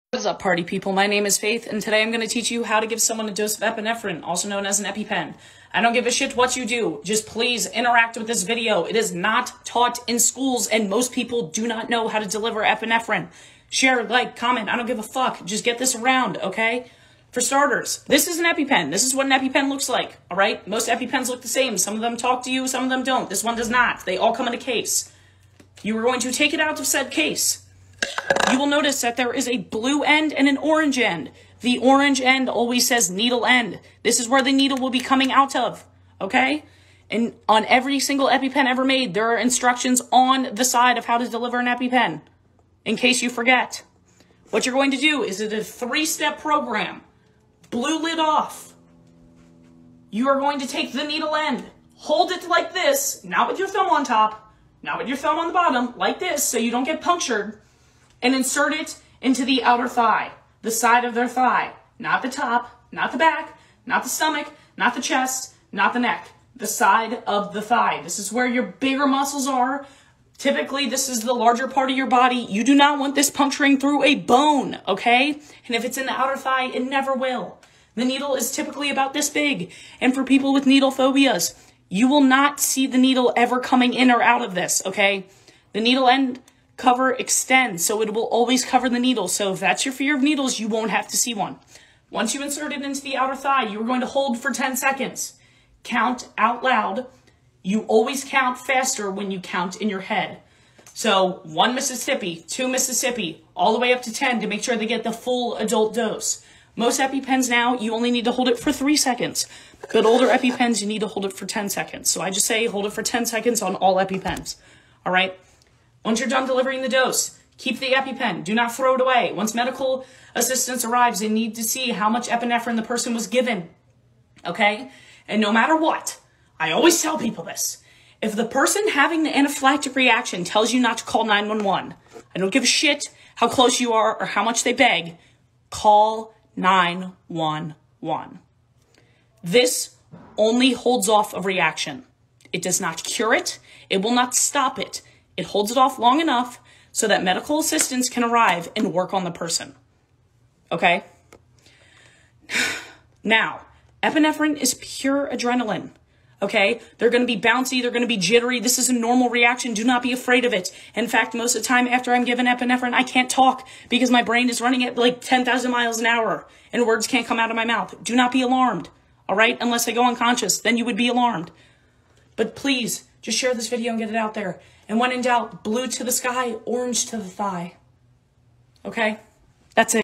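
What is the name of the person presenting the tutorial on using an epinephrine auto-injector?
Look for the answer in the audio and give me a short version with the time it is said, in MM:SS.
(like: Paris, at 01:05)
Faith, at 00:01.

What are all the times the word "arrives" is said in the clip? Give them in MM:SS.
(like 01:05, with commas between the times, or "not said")
02:00, 02:28.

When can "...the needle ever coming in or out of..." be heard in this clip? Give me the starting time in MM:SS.
01:22.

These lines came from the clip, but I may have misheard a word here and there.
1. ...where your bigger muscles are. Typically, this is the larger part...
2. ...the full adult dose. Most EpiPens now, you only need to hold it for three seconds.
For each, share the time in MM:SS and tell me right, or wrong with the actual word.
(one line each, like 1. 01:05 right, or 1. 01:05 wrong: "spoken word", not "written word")
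1. 01:08 right
2. 01:45 right.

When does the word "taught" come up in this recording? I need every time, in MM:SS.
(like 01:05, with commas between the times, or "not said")
00:09.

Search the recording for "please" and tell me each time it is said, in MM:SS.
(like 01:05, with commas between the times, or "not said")
00:07, 02:52.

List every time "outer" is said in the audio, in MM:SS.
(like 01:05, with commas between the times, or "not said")
00:59, 01:16, 01:33.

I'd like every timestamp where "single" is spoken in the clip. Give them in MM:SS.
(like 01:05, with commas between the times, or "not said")
00:37.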